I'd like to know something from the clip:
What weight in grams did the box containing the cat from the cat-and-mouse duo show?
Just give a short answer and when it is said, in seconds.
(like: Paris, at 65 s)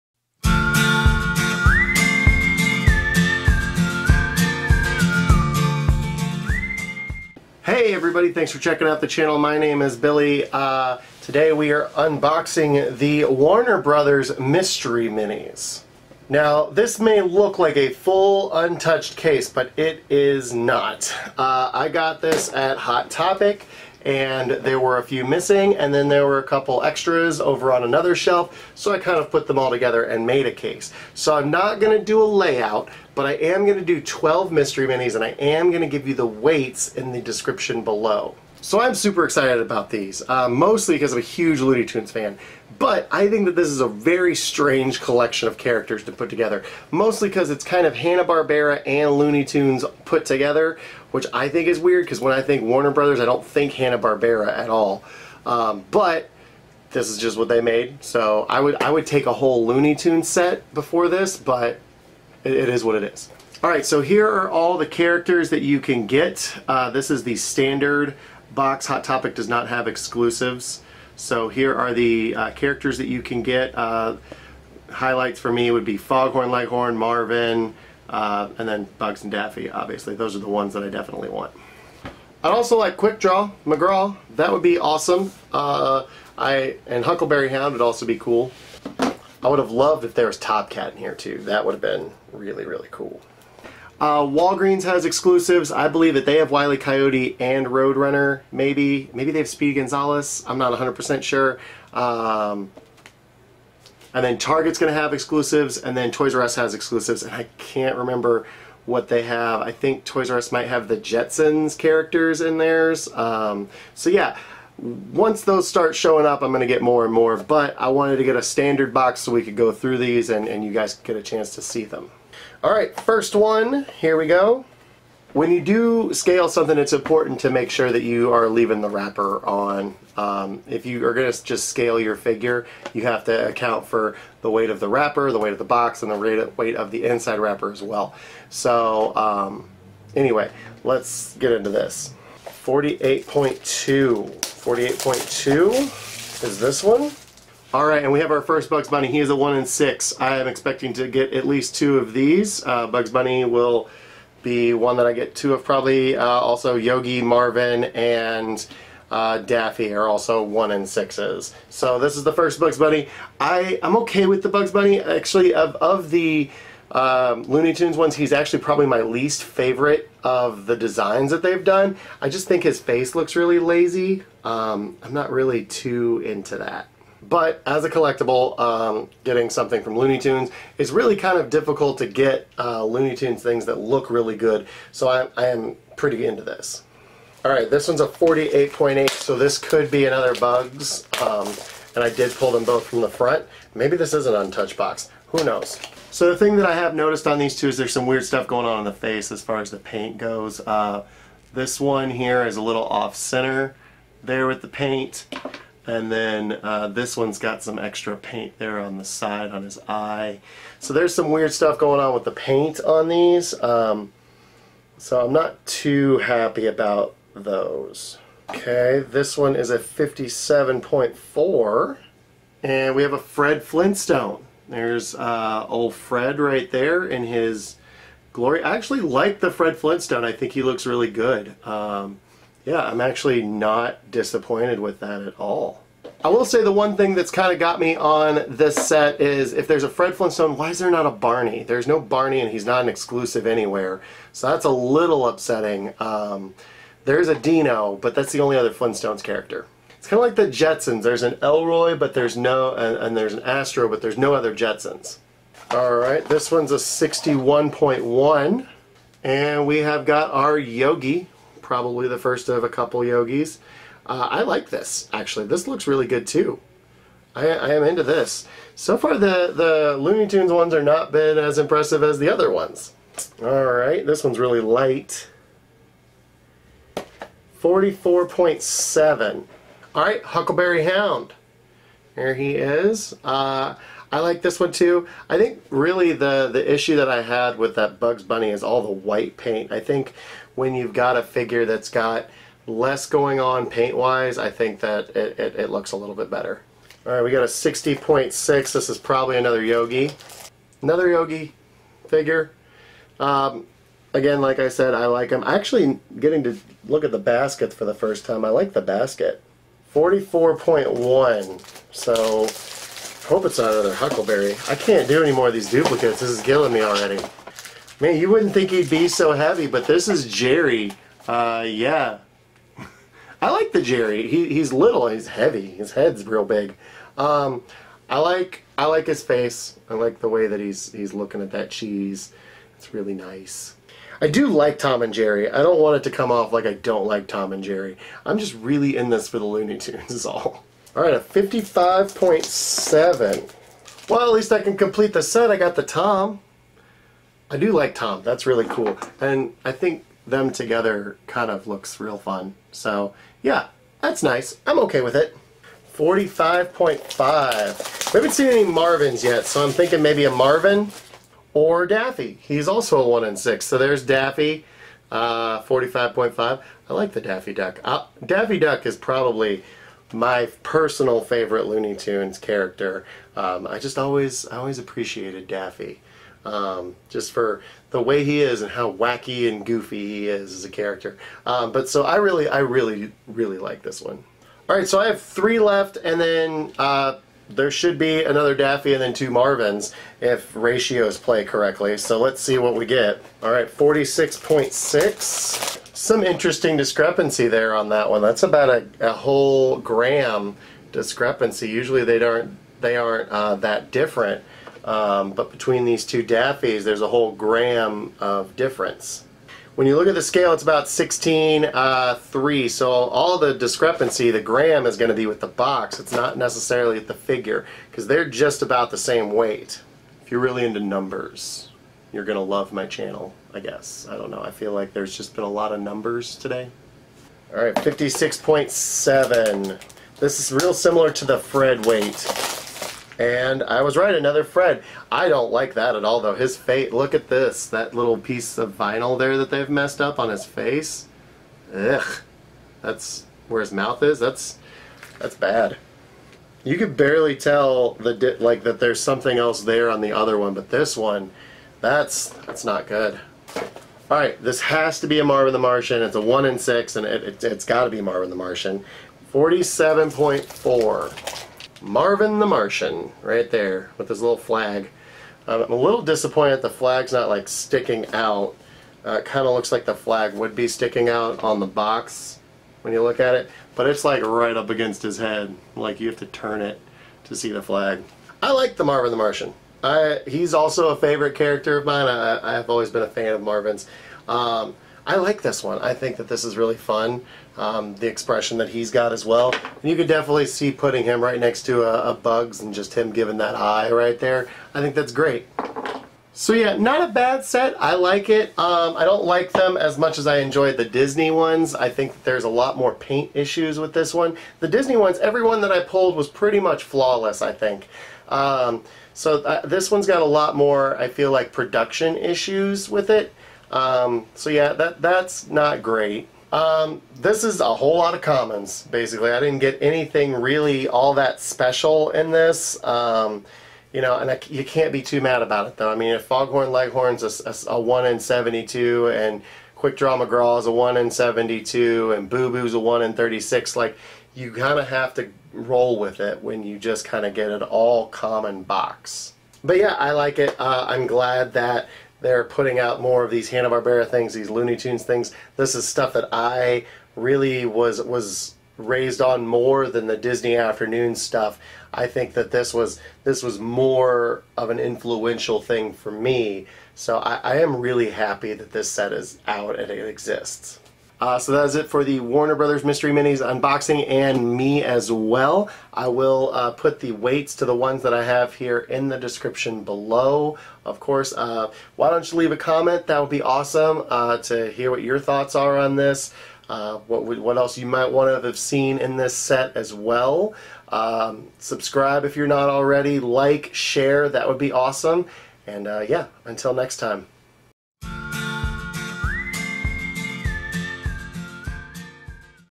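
55.7, at 341 s.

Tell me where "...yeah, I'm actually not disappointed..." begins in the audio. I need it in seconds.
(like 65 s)
232 s.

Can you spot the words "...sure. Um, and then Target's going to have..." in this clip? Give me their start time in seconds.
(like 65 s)
101 s.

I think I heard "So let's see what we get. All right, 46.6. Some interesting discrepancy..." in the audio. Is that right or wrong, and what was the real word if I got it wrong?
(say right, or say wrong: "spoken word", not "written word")
right.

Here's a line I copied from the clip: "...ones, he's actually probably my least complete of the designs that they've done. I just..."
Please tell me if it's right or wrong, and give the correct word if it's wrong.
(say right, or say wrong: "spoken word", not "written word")
wrong: "favorite", not "complete".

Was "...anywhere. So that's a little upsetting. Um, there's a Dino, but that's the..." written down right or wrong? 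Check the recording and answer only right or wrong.
right.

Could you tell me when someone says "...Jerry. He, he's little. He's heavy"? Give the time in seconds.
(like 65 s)
323 s.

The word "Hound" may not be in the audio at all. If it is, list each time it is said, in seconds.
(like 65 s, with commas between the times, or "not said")
87 s, 280 s.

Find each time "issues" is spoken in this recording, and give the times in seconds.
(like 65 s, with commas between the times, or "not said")
286 s, 503 s, 512 s.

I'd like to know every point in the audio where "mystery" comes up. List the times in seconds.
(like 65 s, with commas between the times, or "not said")
14 s, 34 s, 562 s.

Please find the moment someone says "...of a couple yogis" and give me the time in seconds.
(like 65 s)
262 s.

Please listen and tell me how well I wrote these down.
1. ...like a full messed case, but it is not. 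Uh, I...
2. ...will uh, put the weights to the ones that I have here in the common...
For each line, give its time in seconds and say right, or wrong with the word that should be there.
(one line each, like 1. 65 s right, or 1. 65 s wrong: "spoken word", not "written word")
1. 17 s wrong: "untouched", not "messed"
2. 566 s wrong: "description", not "common".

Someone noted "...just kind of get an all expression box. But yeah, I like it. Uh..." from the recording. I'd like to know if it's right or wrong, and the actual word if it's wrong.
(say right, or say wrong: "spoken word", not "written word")
wrong: "common", not "expression".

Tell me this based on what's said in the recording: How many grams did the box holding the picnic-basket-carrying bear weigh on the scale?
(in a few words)
61.1.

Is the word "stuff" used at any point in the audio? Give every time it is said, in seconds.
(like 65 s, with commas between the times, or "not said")
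198 s, 211 s, 545 s, 551 s.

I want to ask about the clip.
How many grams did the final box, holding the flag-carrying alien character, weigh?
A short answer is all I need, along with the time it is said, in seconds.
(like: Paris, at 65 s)
47.4, at 459 s.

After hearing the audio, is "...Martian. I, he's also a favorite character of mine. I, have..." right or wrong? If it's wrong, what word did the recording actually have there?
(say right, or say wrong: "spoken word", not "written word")
right.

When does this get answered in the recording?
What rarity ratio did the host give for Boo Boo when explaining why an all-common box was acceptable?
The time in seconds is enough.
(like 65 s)
532 s.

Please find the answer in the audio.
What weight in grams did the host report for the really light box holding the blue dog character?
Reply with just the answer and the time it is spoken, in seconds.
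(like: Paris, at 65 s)
44.7, at 277 s.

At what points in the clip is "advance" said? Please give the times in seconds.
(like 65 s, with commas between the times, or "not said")
not said.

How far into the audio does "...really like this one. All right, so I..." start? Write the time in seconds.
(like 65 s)
383 s.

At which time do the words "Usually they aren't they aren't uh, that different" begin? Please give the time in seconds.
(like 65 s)
401 s.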